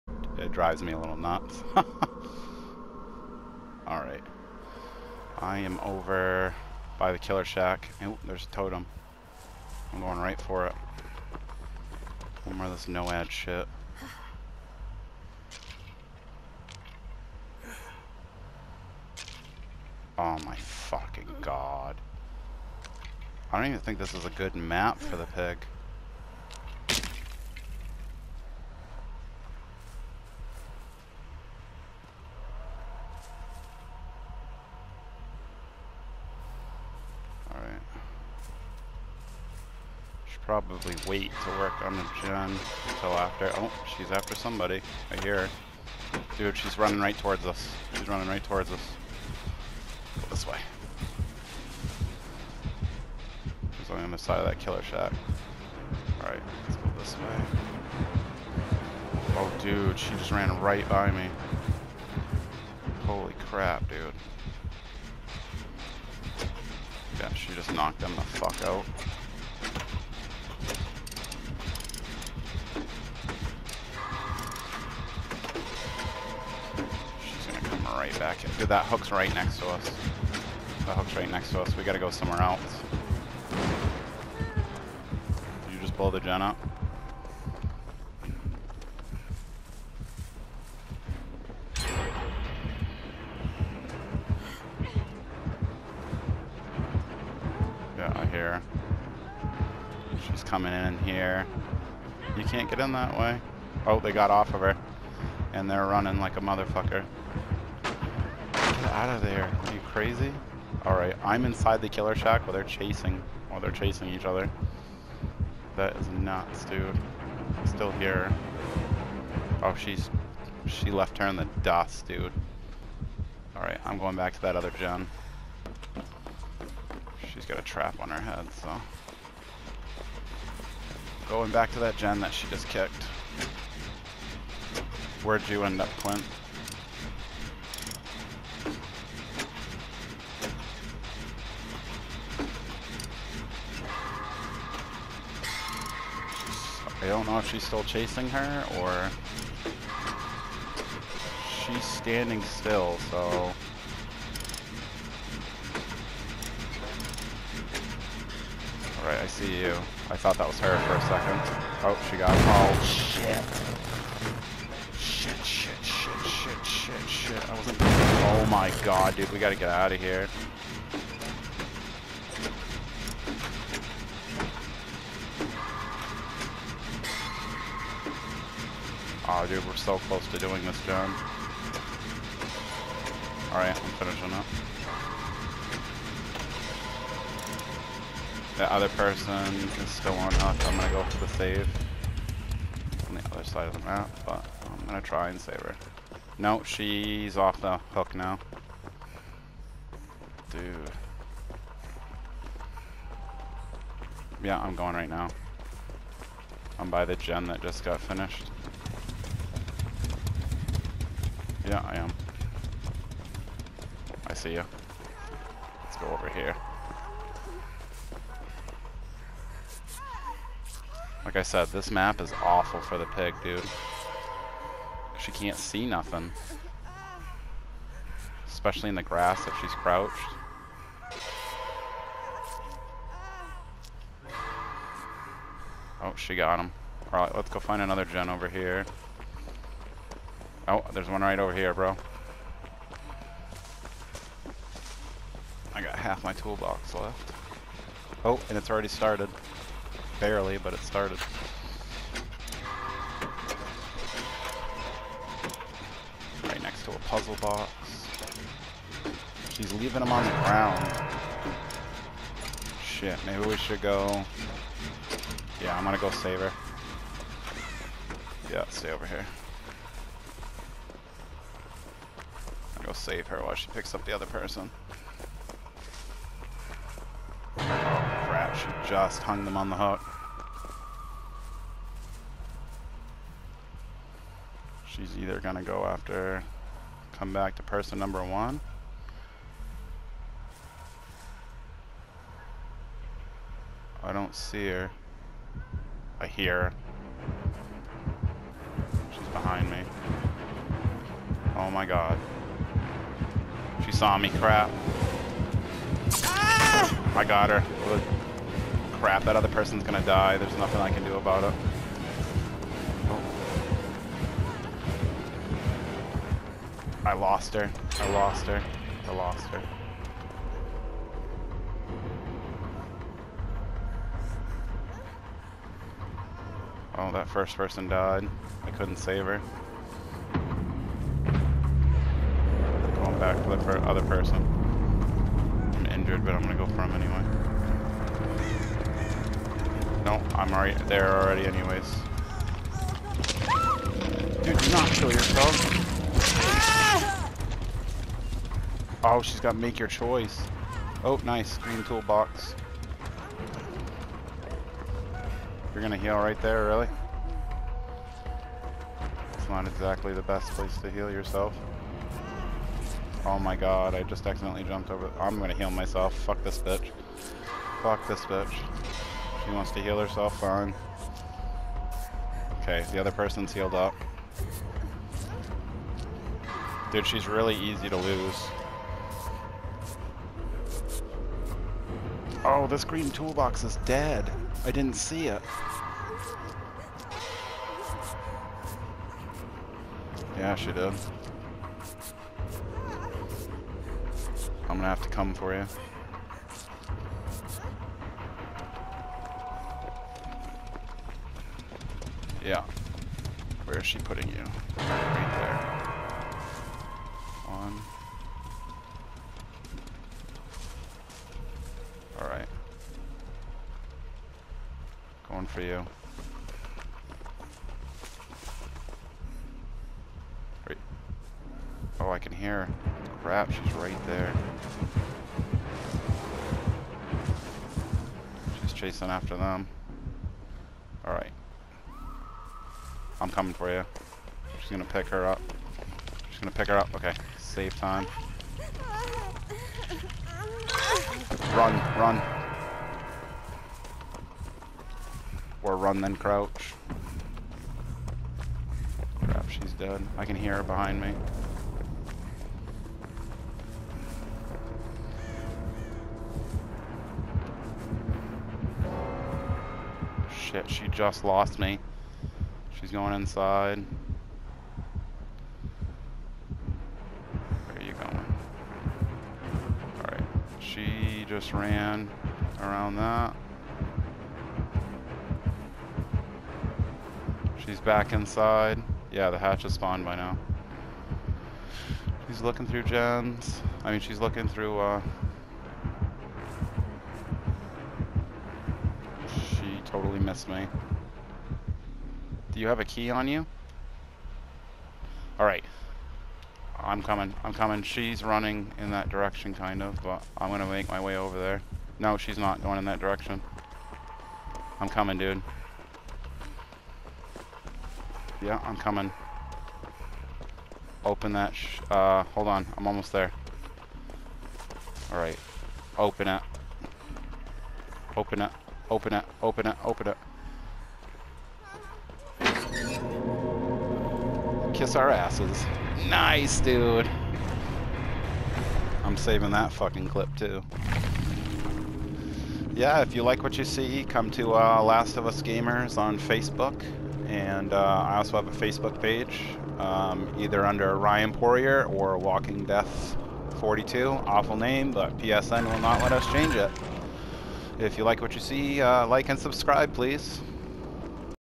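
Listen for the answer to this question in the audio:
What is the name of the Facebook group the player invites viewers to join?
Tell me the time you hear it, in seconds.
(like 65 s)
534 s.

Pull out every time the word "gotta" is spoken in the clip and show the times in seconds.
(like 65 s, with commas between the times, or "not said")
81 s, 169 s.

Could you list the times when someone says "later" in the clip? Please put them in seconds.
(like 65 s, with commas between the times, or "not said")
not said.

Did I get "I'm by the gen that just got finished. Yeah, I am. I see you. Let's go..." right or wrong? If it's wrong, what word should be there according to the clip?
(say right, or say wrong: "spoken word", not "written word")
right.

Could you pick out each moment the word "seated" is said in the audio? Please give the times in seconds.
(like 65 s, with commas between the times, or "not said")
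not said.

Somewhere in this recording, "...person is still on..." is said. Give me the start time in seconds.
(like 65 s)
188 s.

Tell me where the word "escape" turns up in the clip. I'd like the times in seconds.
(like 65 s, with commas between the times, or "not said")
not said.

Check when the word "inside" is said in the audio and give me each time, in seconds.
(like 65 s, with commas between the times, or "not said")
111 s, 463 s, 478 s.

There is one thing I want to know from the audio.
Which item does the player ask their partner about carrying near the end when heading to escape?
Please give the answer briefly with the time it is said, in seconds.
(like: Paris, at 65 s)
A key, at 492 s.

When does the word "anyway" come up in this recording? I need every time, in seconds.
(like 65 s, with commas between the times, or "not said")
336 s, 341 s.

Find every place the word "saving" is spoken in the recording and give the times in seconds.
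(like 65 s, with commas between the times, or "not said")
529 s.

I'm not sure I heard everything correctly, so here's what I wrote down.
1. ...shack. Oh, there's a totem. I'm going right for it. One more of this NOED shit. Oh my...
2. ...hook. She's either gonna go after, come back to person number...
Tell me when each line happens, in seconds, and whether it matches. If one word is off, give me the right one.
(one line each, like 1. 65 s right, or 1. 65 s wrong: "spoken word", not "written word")
1. 7 s right
2. 279 s right.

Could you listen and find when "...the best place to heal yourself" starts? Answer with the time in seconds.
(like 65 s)
360 s.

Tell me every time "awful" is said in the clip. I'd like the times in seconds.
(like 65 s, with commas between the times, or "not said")
222 s, 544 s.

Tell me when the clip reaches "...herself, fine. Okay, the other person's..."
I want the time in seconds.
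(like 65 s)
369 s.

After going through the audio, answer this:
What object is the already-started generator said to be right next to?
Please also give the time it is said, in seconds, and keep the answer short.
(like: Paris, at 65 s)
A puzzle box, at 257 s.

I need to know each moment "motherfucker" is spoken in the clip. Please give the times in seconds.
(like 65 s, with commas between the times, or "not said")
106 s.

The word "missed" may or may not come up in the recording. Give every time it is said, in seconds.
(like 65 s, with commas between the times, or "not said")
490 s.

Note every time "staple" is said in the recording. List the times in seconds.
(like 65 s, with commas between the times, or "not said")
not said.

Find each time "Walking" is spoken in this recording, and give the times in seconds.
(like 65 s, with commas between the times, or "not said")
542 s.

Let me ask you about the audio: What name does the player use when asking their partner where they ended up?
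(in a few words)
Clint.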